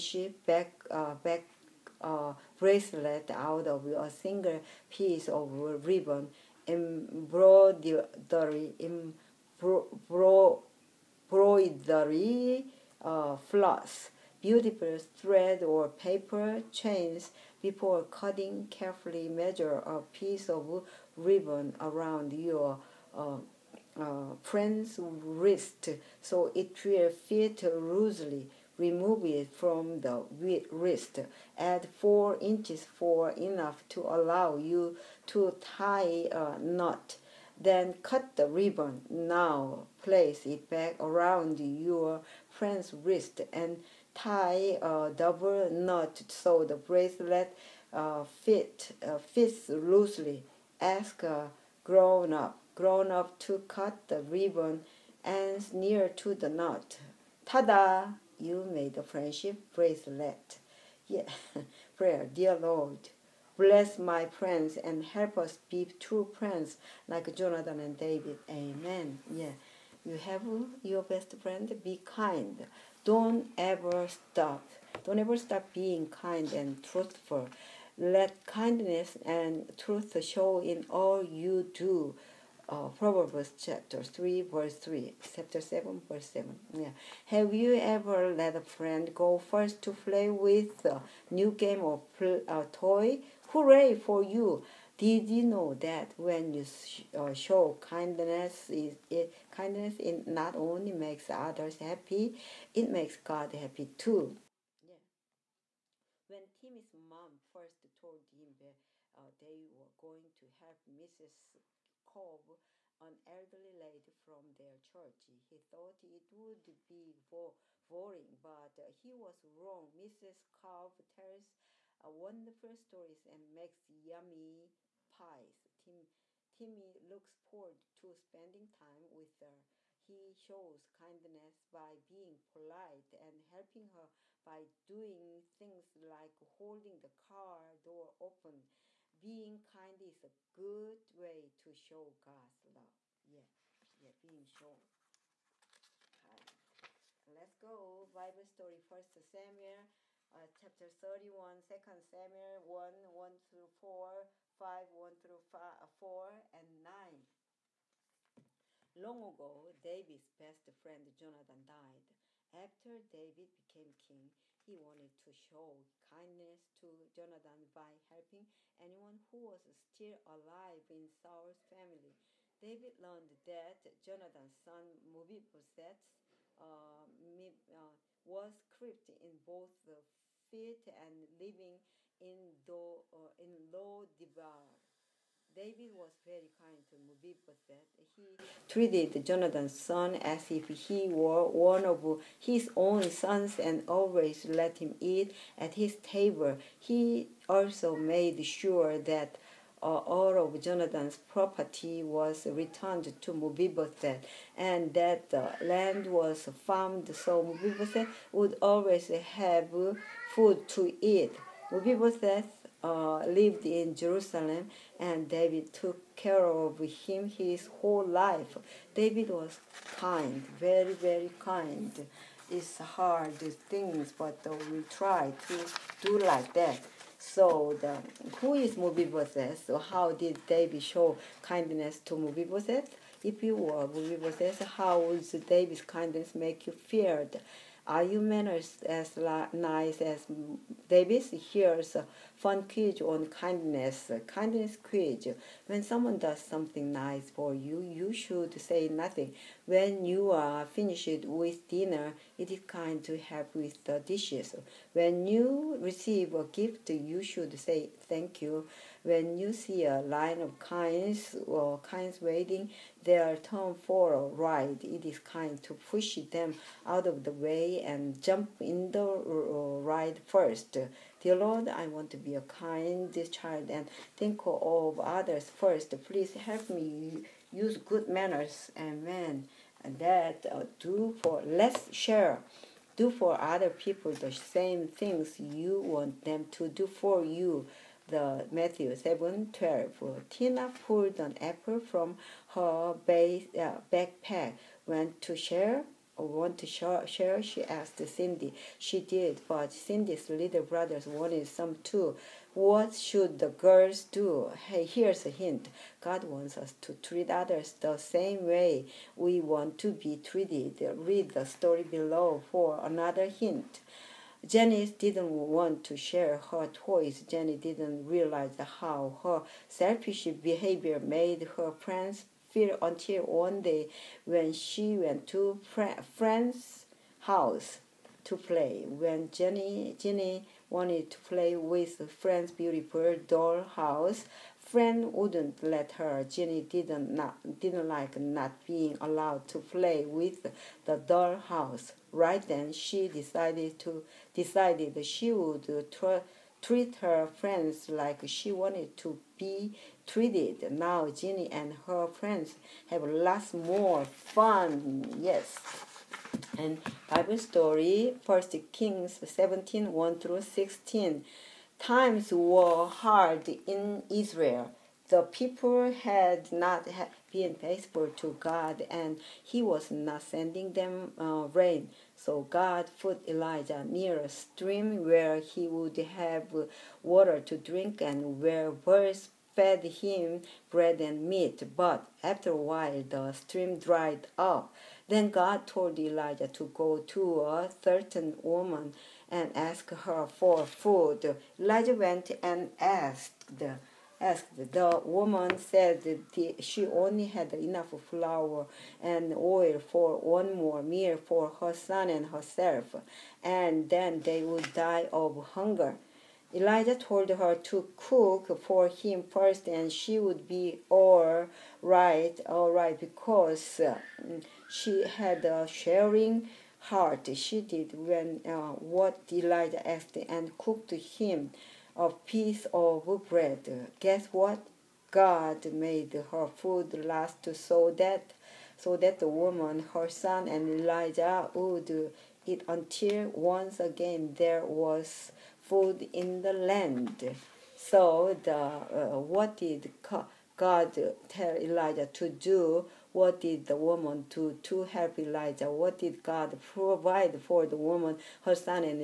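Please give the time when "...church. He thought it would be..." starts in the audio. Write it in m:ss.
1:54.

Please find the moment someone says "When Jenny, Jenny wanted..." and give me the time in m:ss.
5:28.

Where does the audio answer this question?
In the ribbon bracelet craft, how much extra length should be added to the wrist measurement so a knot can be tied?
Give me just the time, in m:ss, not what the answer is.
0:31.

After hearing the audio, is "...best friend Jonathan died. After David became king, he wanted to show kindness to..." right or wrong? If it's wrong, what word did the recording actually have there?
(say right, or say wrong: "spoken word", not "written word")
right.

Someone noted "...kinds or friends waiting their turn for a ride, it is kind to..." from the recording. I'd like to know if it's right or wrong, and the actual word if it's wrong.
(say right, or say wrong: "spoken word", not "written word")
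wrong: "kinds", not "friends".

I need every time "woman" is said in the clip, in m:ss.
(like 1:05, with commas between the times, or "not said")
6:28, 6:35, 7:09, 7:23, 7:27.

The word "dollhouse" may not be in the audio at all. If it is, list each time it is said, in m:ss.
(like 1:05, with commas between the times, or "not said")
5:33, 5:40.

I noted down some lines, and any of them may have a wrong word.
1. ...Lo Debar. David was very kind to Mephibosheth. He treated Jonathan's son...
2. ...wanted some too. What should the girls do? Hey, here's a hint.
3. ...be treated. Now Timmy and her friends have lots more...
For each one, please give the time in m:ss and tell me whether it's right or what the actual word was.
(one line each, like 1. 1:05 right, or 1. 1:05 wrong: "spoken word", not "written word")
1. 3:03 right
2. 5:01 right
3. 5:49 wrong: "Ginny", not "Timmy".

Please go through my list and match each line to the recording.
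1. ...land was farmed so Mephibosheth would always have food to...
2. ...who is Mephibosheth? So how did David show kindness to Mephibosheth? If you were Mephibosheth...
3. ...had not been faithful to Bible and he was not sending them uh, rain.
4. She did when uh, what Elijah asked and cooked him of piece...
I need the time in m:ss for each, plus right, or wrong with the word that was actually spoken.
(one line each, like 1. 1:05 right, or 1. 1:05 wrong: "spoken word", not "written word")
1. 3:25 right
2. 3:48 right
3. 6:05 wrong: "God", not "Bible"
4. 6:57 right.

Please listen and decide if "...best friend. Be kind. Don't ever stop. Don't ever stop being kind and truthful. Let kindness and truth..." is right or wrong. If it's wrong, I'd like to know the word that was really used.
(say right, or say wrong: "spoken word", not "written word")
right.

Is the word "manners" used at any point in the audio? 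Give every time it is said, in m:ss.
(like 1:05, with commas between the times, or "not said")
3:58, 4:38.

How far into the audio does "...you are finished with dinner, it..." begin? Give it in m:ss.
4:10.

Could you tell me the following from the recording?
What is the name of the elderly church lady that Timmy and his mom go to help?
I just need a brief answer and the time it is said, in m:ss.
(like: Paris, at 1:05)
Mrs. Cobb, at 1:59.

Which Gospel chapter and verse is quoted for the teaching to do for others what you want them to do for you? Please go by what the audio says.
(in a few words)
Matthew 7:12.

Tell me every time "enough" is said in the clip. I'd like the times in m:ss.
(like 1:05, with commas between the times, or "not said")
0:33, 6:37.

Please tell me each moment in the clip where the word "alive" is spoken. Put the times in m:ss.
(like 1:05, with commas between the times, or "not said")
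2:50.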